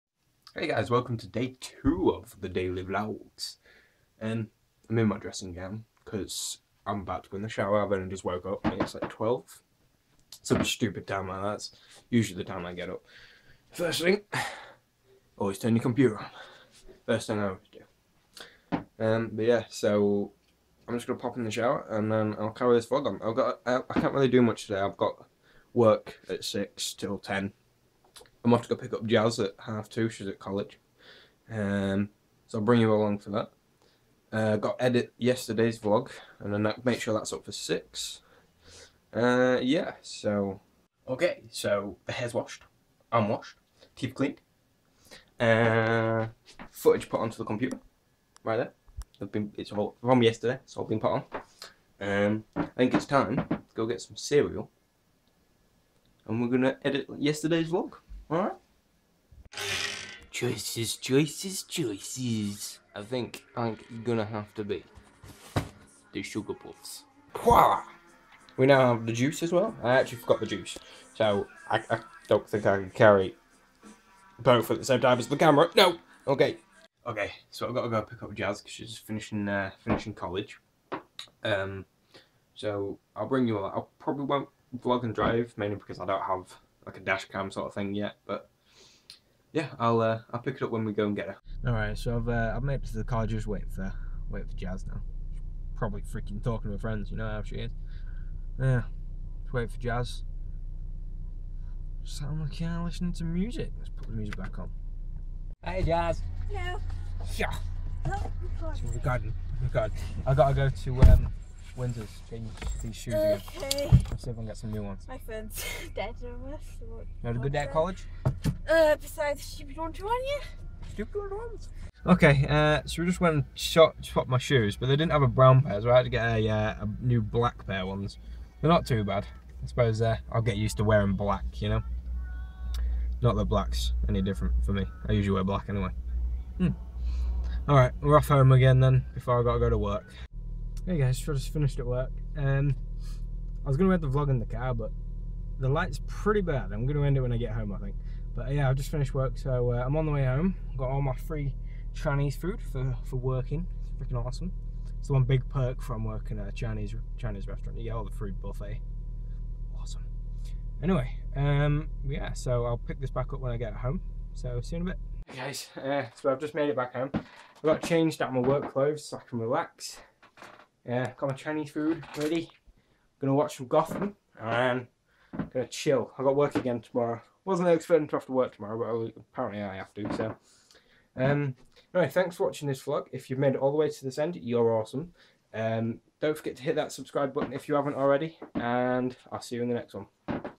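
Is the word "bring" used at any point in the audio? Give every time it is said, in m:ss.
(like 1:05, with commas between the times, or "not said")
0:32, 1:23.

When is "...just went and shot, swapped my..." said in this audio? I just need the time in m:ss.
2:03.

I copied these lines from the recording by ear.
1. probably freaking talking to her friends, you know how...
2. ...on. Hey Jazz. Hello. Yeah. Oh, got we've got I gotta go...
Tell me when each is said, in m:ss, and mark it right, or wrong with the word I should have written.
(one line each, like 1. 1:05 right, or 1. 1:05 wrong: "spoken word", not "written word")
1. 1:35 right
2. 1:44 right.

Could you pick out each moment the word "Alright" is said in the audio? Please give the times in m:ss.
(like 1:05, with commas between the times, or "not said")
0:58, 2:17.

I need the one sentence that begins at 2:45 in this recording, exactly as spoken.
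Hey guys, uh, so I've just made it back home.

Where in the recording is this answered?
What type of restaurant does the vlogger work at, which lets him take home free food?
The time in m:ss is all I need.
2:37.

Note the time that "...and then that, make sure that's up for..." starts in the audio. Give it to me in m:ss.
0:36.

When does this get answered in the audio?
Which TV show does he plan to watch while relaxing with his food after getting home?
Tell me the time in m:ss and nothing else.
2:53.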